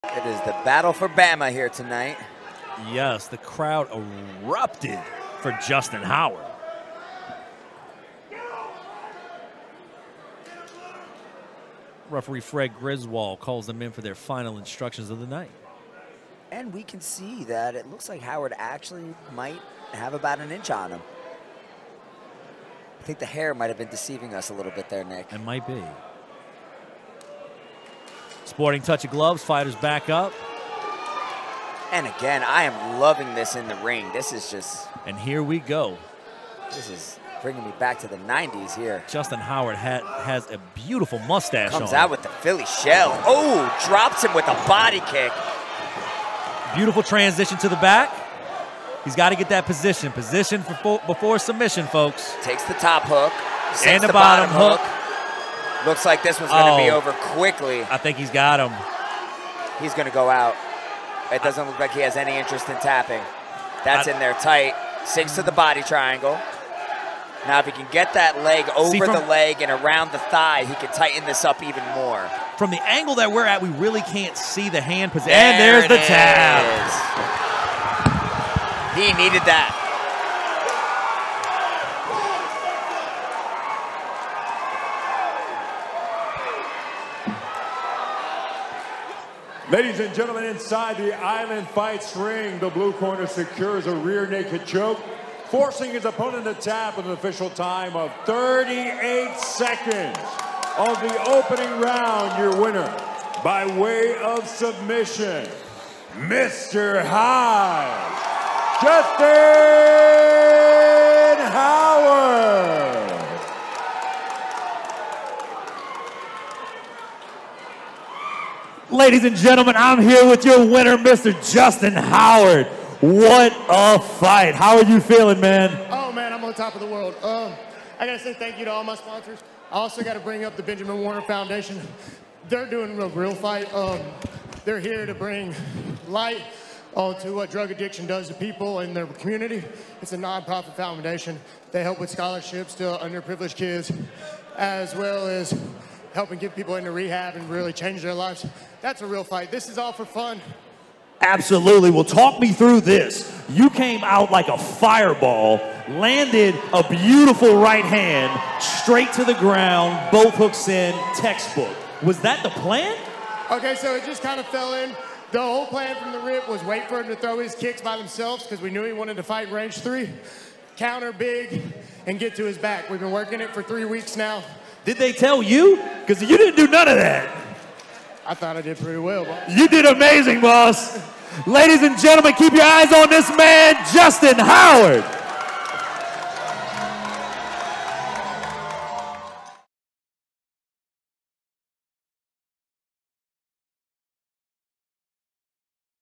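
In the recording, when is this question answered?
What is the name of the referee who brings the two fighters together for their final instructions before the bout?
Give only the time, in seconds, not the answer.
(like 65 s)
12 s.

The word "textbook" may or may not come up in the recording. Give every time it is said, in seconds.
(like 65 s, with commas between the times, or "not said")
161 s.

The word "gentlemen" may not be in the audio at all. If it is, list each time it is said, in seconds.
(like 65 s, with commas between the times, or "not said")
90 s, 119 s, 181 s.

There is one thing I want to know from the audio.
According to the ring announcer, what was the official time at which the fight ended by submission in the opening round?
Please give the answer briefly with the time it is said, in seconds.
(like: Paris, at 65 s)
38 seconds, at 98 s.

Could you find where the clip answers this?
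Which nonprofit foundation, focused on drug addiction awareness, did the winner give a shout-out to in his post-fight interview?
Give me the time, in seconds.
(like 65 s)
130 s.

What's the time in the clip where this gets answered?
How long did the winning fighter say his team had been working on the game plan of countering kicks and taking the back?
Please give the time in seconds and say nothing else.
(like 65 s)
173 s.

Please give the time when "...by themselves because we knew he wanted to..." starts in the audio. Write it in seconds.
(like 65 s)
167 s.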